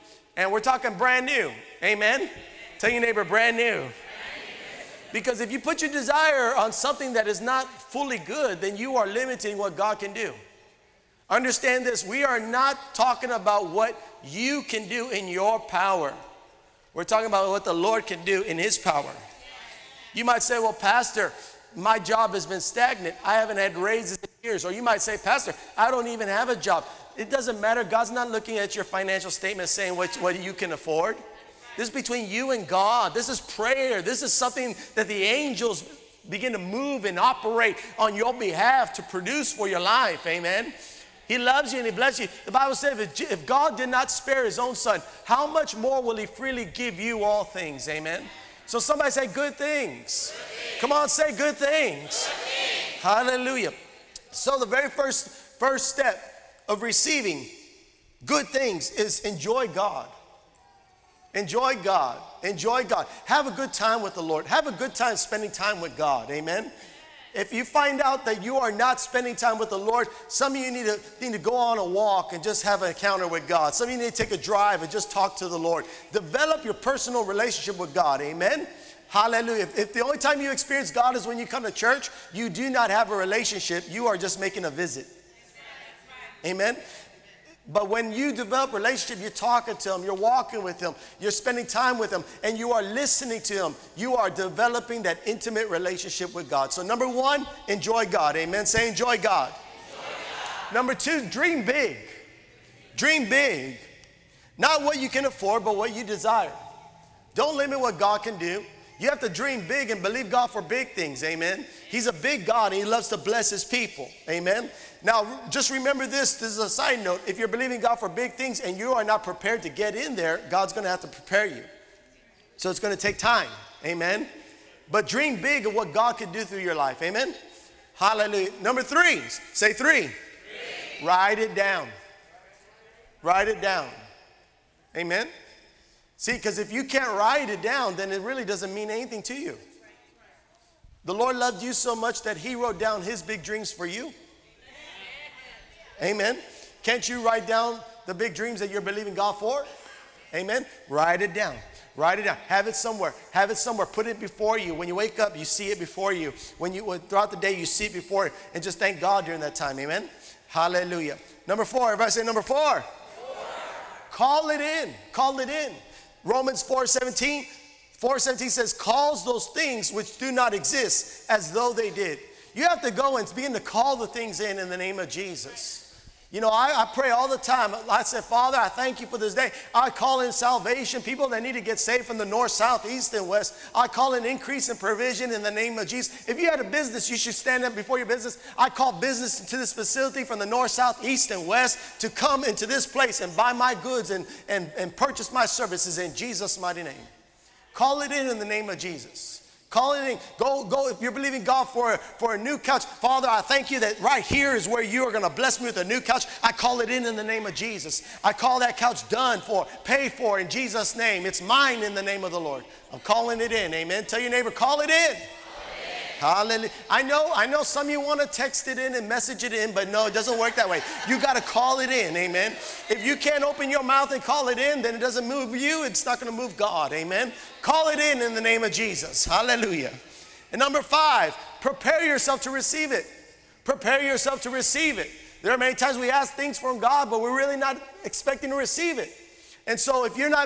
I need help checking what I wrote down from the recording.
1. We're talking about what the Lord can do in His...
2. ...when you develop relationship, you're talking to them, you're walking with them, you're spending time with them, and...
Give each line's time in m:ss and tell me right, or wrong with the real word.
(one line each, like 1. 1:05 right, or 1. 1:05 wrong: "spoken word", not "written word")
1. 0:16 right
2. 1:27 right.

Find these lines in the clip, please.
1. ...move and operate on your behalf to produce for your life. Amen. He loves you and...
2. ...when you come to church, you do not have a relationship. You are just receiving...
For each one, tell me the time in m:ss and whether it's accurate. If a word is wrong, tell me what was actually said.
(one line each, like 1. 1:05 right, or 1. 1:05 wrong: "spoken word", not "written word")
1. 0:36 right
2. 1:21 wrong: "making", not "receiving".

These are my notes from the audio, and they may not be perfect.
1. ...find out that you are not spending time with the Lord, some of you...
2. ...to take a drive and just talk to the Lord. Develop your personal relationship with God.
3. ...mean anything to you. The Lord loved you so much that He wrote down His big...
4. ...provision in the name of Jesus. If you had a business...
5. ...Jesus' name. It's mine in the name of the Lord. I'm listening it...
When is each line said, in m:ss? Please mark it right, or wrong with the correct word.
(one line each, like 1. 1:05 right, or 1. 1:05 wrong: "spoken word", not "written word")
1. 1:07 right
2. 1:14 right
3. 2:18 right
4. 3:04 right
5. 3:30 wrong: "calling", not "listening".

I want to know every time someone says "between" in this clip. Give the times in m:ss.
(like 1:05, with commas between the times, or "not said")
0:31.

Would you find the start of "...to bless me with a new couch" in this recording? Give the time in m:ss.
3:25.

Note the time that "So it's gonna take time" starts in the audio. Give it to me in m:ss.
2:02.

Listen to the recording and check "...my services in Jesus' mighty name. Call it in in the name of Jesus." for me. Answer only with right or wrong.
right.